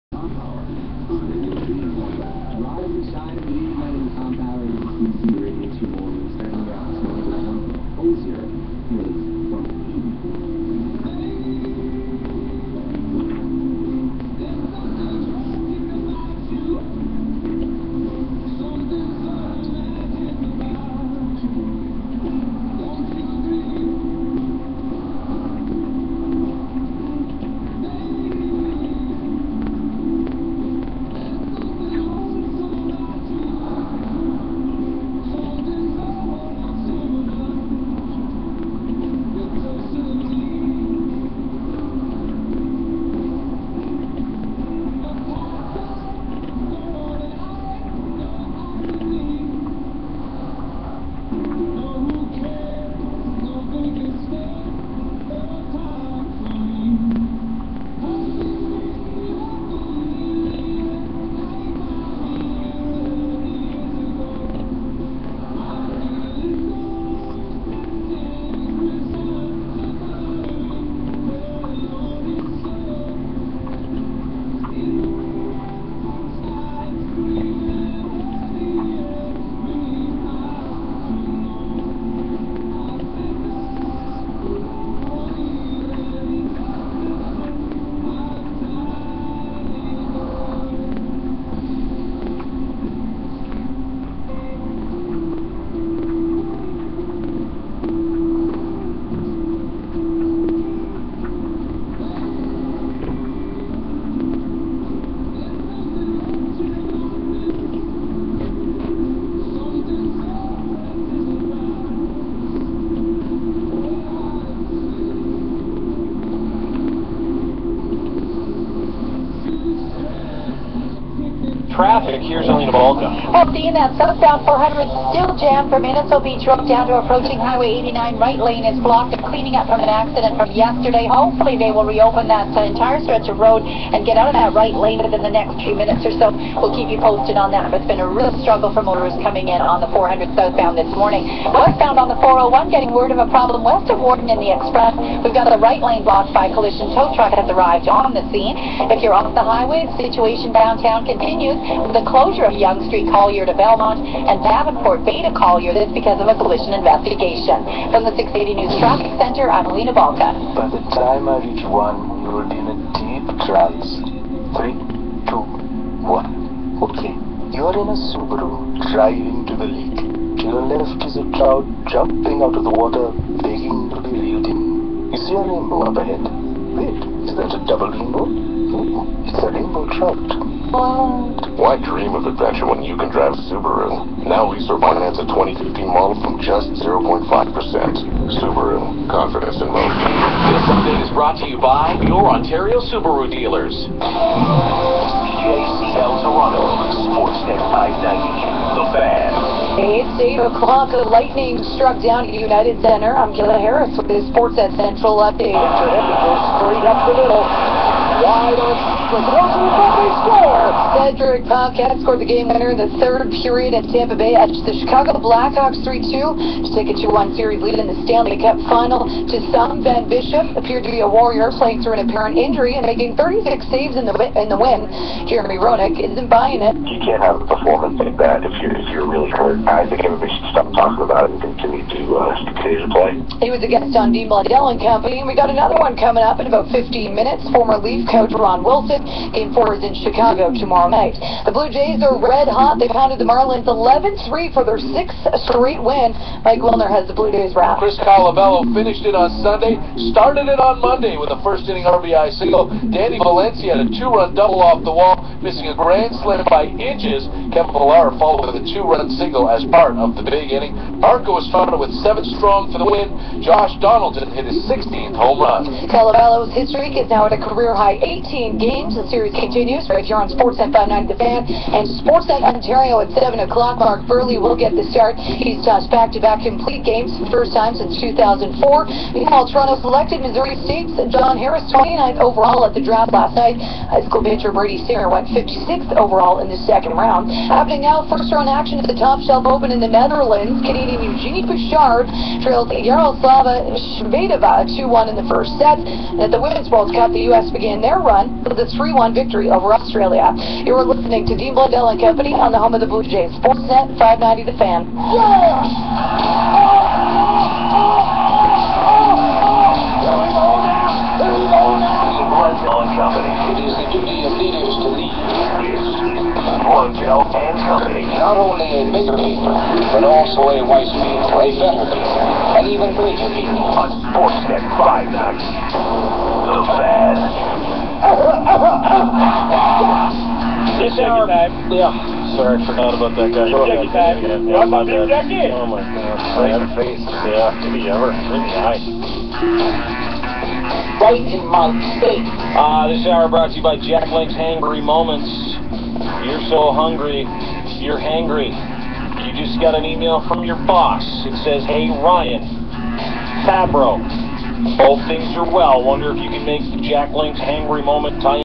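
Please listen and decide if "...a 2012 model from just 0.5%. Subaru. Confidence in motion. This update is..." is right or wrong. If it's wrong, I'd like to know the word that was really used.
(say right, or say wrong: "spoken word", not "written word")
wrong: "2015", not "2012".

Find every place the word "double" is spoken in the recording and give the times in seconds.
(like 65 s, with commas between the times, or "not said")
177 s, 254 s.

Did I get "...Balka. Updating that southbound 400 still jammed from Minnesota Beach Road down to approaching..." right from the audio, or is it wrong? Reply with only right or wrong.
right.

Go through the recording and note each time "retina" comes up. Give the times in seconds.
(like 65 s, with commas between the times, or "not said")
not said.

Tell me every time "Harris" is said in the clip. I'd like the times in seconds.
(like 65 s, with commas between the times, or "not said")
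203 s, 281 s.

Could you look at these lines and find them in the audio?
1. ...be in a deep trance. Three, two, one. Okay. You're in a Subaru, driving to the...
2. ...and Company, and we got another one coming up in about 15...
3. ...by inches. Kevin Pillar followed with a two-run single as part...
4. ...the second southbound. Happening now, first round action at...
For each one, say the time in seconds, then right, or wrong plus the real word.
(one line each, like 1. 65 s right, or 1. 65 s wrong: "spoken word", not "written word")
1. 162 s right
2. 234 s right
3. 256 s right
4. 286 s wrong: "round", not "southbound".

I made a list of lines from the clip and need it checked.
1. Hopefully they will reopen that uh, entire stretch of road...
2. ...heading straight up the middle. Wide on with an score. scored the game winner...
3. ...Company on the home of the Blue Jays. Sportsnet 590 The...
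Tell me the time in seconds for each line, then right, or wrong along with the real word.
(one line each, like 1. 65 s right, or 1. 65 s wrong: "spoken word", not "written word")
1. 131 s right
2. 205 s right
3. 302 s right.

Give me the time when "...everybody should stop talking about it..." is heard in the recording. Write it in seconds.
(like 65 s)
230 s.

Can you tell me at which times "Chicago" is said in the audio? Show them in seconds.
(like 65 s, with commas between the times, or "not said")
214 s, 239 s.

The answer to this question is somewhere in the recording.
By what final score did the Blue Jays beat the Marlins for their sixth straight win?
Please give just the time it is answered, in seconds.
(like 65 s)
243 s.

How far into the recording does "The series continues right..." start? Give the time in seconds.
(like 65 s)
268 s.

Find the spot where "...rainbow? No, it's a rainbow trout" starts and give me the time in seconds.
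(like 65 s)
177 s.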